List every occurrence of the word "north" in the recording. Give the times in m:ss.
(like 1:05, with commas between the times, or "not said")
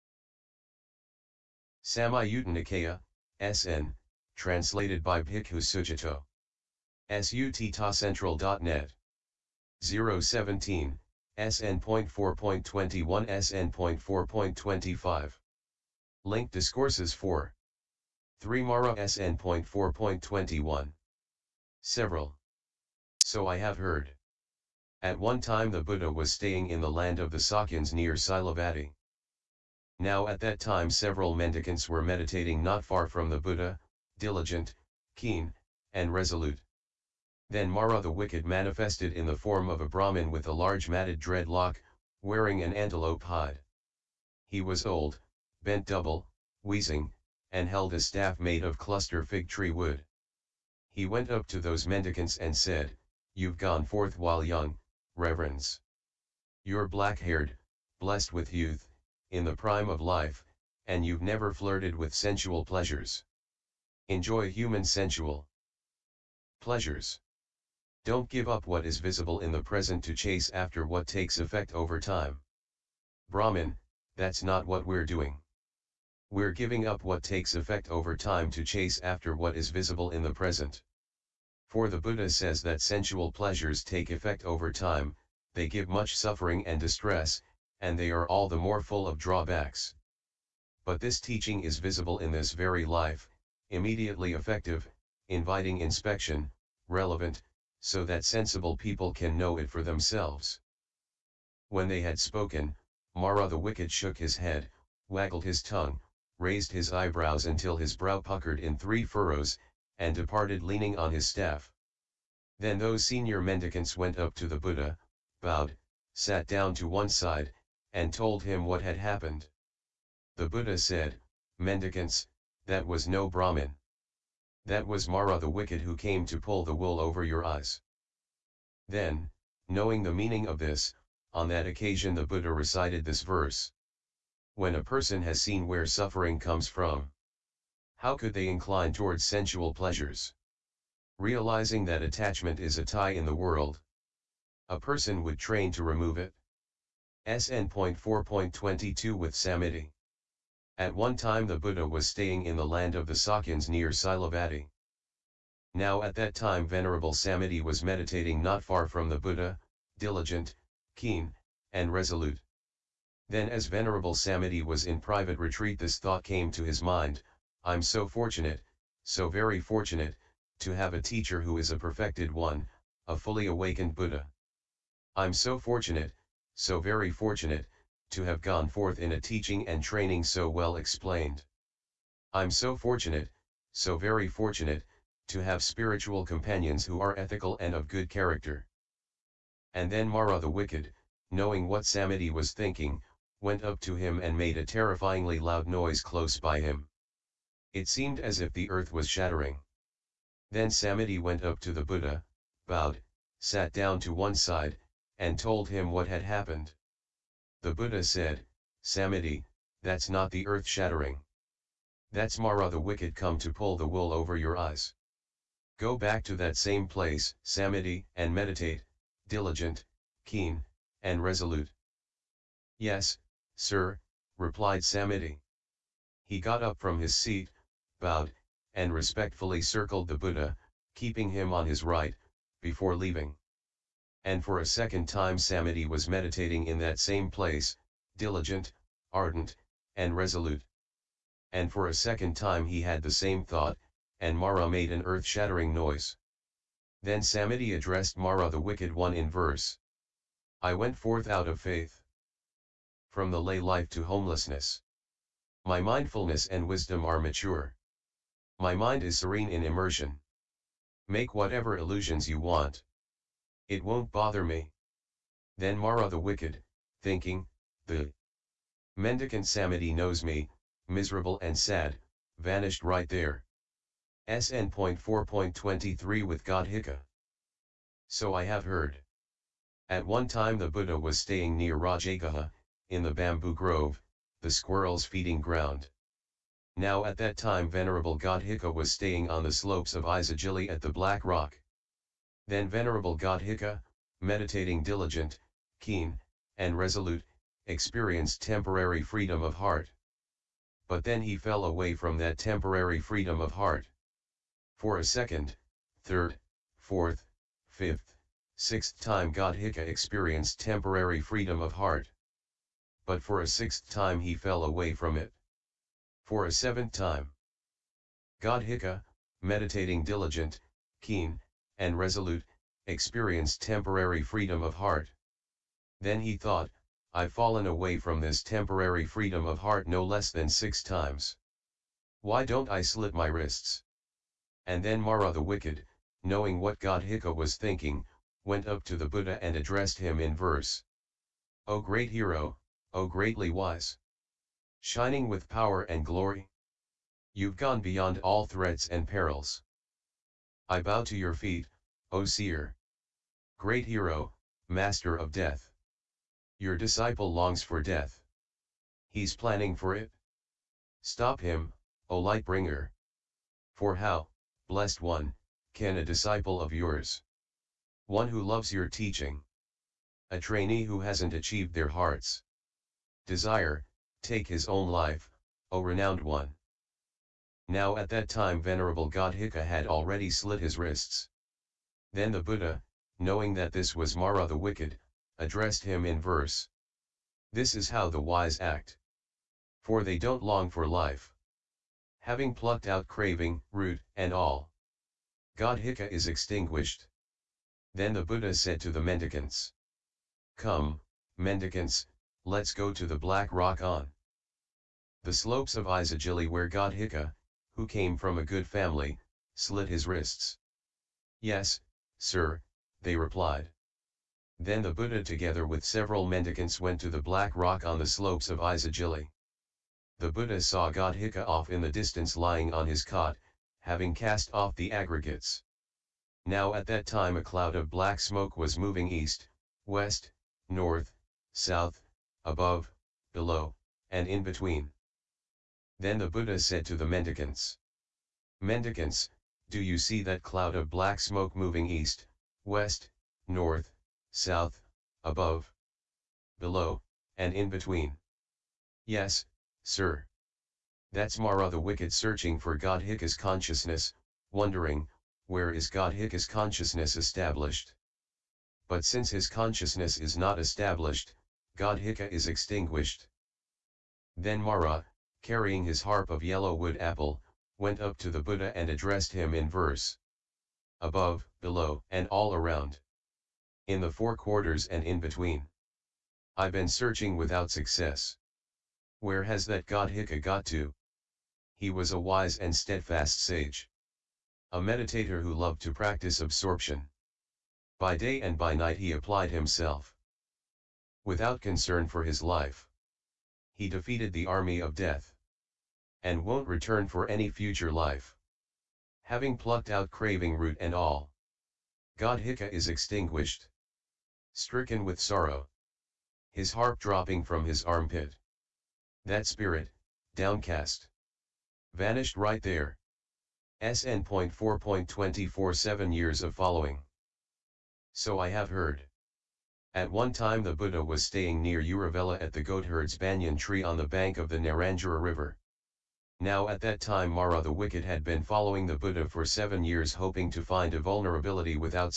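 7:10, 7:23.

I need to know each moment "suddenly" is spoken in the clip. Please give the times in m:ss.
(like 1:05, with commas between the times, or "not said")
not said.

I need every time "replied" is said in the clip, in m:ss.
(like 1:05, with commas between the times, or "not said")
3:44, 6:53.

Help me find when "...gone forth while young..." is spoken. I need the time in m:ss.
0:53.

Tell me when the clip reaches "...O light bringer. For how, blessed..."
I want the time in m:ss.
6:02.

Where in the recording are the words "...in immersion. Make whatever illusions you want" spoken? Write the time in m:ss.
4:19.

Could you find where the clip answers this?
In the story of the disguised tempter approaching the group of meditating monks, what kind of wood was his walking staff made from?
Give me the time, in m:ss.
0:48.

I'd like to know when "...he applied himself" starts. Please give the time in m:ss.
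8:08.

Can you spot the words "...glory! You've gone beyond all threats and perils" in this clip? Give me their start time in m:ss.
5:46.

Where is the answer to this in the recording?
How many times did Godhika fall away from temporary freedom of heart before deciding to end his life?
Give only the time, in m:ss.
5:30.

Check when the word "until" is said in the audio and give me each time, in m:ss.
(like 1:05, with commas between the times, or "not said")
1:47.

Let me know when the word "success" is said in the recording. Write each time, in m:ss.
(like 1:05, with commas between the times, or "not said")
7:57.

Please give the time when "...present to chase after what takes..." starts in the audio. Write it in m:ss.
1:09.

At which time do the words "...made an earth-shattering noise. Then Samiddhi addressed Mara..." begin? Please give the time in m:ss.
4:04.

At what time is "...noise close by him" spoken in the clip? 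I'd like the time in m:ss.
3:15.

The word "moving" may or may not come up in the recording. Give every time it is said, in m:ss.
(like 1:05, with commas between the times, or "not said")
7:08, 7:21.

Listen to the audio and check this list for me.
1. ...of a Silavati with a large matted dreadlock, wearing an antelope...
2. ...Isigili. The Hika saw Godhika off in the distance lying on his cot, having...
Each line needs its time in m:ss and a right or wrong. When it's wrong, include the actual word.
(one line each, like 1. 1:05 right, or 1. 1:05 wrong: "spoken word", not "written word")
1. 0:39 wrong: "Brahmin", not "Silavati"
2. 6:58 wrong: "Buddha", not "Hika".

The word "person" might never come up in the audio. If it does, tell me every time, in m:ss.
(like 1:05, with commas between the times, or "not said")
2:14, 2:24.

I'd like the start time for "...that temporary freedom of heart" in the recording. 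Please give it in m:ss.
5:02.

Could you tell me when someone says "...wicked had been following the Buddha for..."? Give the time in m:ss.
8:47.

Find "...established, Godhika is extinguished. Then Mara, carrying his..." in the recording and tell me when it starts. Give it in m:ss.
7:40.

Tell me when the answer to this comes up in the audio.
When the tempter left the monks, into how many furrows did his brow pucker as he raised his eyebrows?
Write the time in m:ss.
1:48.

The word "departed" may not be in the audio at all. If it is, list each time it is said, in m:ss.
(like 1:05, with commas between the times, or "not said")
1:50.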